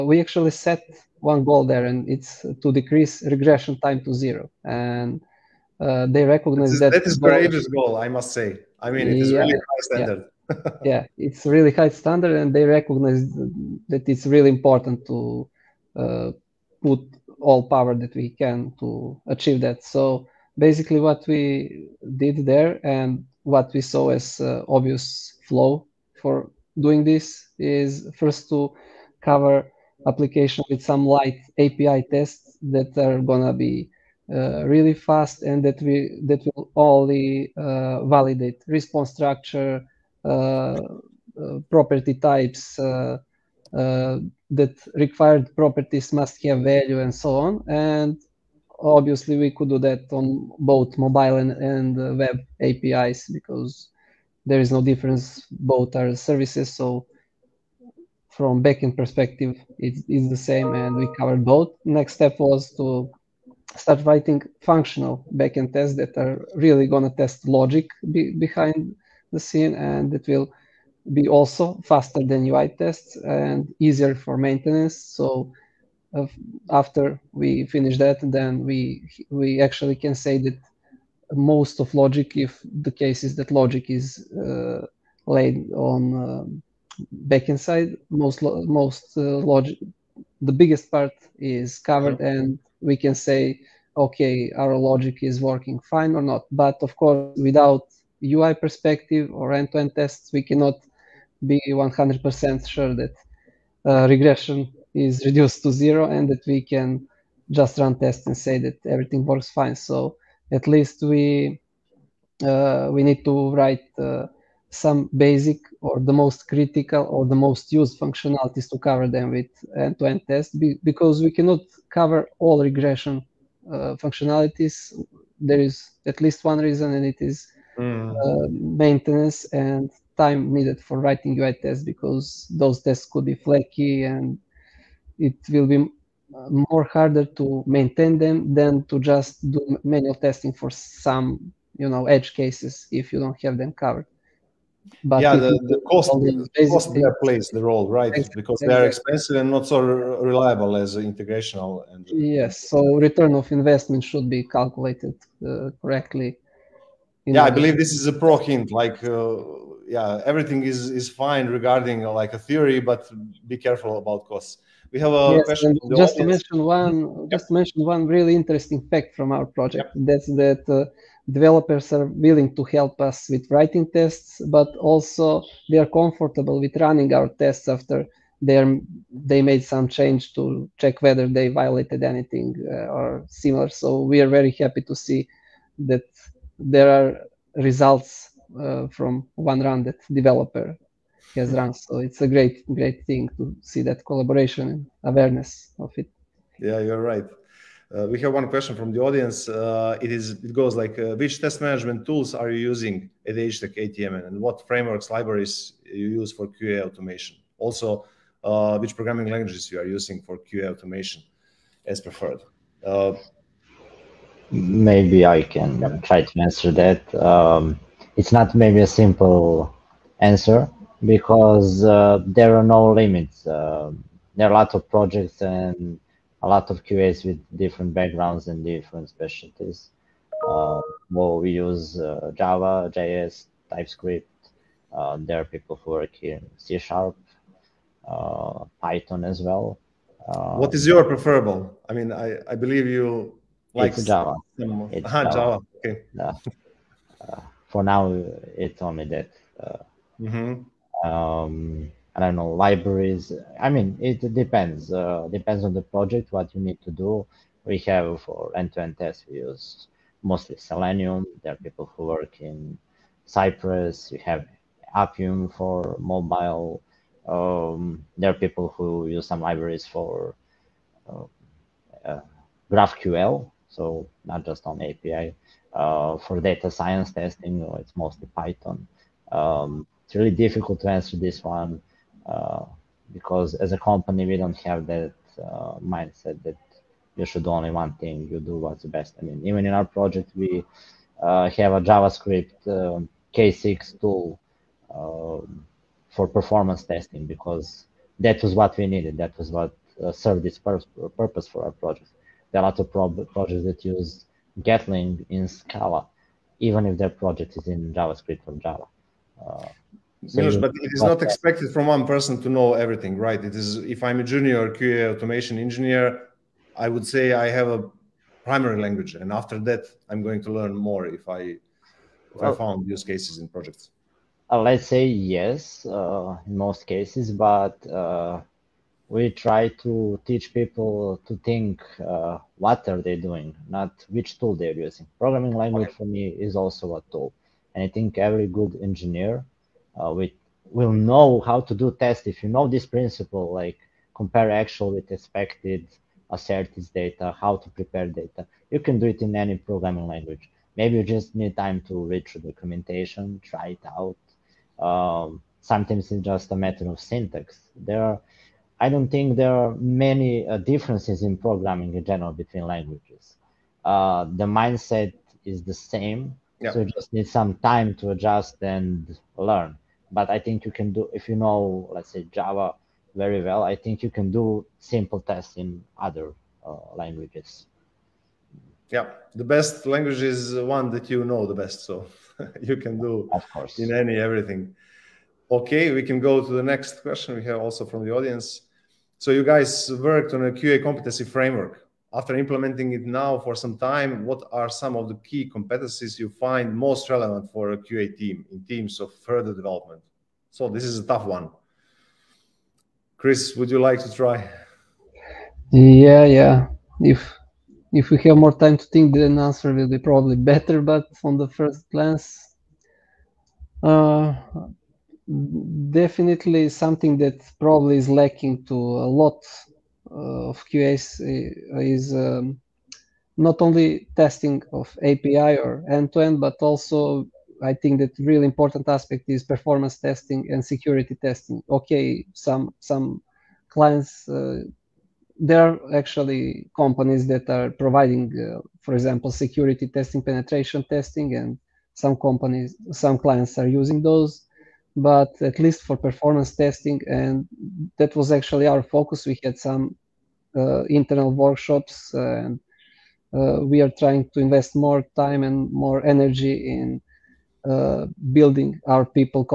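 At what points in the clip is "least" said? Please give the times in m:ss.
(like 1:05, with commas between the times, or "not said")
1:50, 2:06, 7:25.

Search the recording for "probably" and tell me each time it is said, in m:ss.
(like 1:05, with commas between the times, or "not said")
6:49, 6:57.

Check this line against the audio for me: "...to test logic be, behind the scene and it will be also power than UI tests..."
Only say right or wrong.
wrong.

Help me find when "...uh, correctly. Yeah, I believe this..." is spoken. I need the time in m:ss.
2:35.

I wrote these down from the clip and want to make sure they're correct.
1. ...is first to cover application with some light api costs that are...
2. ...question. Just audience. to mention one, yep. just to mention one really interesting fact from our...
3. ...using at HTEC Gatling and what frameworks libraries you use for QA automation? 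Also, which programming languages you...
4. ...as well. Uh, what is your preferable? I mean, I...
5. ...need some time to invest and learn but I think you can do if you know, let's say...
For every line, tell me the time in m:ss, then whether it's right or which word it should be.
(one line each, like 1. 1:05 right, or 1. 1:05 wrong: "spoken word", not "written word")
1. 0:27 wrong: "tests", not "costs"
2. 2:45 right
3. 3:22 wrong: "ATM", not "Gatling"
4. 3:59 right
5. 6:07 wrong: "adjust", not "invest".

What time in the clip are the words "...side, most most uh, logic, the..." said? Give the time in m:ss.
1:27.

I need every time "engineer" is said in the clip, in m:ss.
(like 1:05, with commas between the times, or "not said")
5:15, 5:38.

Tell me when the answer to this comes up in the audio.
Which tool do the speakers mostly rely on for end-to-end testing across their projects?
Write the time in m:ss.
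4:20.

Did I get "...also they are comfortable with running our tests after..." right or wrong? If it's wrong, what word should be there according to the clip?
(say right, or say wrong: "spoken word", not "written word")
right.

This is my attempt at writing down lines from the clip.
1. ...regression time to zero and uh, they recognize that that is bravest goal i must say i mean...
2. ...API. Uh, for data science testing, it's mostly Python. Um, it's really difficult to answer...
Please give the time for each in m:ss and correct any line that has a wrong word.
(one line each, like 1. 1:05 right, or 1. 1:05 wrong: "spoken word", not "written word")
1. 0:03 right
2. 4:34 right.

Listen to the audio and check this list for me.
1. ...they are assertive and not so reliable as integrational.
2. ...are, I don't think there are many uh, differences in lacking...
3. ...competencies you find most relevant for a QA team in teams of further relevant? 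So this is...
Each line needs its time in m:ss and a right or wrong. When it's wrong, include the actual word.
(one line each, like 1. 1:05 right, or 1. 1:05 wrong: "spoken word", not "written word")
1. 2:28 wrong: "expensive", not "assertive"
2. 5:58 wrong: "programming", not "lacking"
3. 6:35 wrong: "development", not "relevant".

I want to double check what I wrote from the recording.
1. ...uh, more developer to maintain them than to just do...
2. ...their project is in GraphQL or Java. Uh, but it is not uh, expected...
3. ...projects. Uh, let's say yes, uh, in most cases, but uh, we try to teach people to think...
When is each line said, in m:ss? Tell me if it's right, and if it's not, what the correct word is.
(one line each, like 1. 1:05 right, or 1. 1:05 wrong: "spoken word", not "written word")
1. 2:15 wrong: "harder", not "developer"
2. 5:06 wrong: "JavaScript", not "GraphQL"
3. 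5:23 right.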